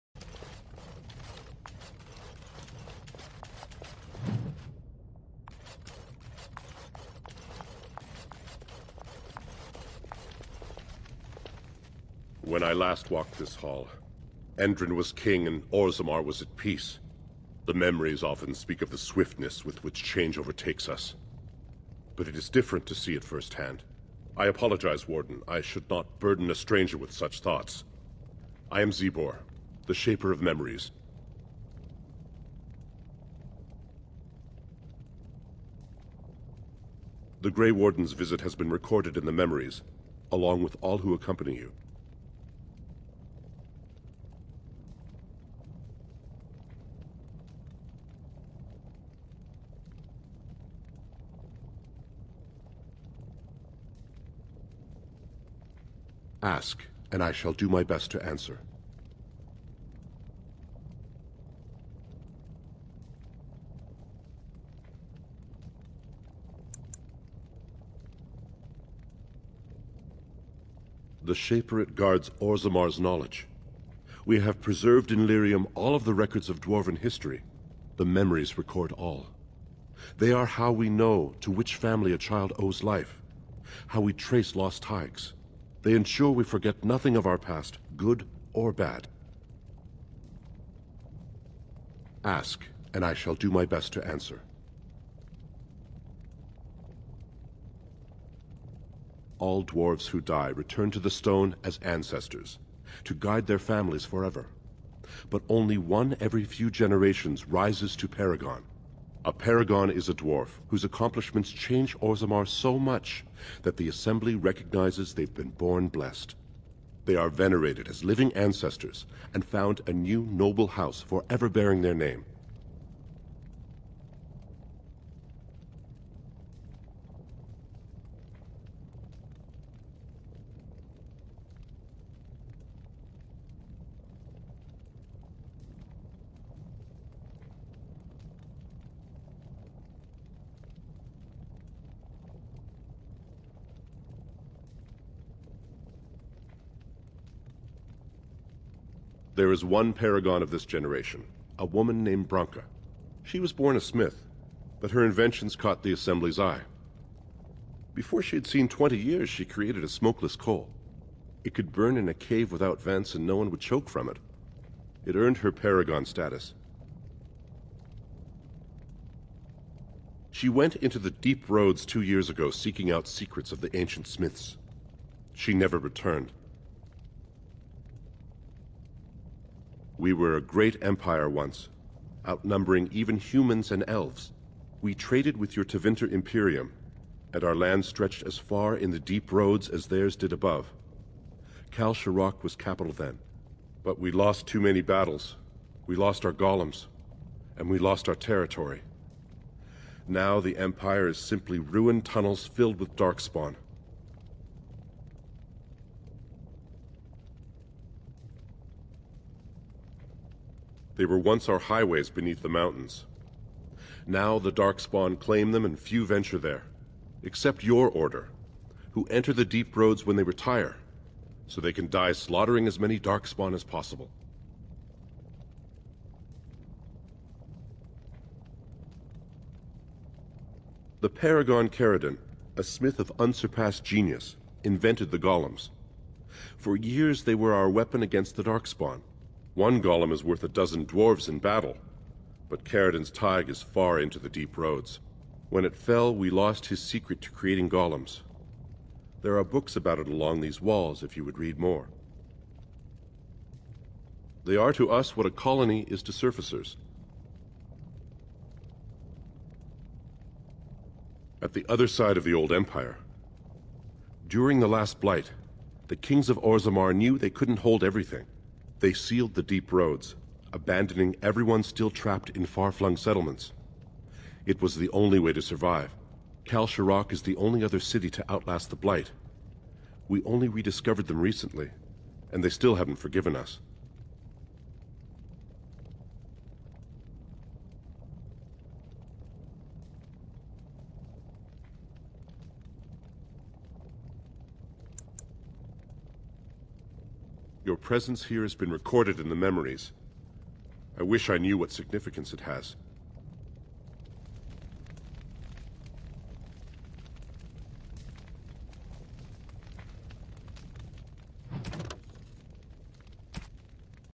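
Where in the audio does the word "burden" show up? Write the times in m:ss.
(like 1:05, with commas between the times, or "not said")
0:26.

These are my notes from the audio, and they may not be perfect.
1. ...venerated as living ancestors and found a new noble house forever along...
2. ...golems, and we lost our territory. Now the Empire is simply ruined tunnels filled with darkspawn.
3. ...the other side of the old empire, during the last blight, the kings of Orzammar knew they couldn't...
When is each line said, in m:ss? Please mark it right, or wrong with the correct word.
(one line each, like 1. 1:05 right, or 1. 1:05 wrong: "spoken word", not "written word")
1. 1:57 wrong: "bearing", not "along"
2. 3:16 right
3. 4:21 right.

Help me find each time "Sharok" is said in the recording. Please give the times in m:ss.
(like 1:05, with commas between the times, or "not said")
3:11, 4:36.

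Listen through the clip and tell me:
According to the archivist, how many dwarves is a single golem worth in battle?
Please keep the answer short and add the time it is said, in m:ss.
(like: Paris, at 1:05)
12, at 4:00.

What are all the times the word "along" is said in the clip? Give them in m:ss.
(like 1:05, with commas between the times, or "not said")
0:40, 4:10.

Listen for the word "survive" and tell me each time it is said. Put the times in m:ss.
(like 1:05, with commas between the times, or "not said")
4:35.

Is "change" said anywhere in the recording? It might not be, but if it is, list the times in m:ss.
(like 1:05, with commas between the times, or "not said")
0:20, 1:51.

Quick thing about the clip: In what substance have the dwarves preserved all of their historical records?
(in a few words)
Lyrium.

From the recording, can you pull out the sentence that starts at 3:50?
The Paragon Caridin, a smith of unsurpassed genius, invented the golems.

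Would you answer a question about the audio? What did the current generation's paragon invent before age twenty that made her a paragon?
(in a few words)
smokeless coal.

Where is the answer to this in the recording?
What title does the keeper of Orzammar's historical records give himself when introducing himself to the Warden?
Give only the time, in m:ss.
0:29.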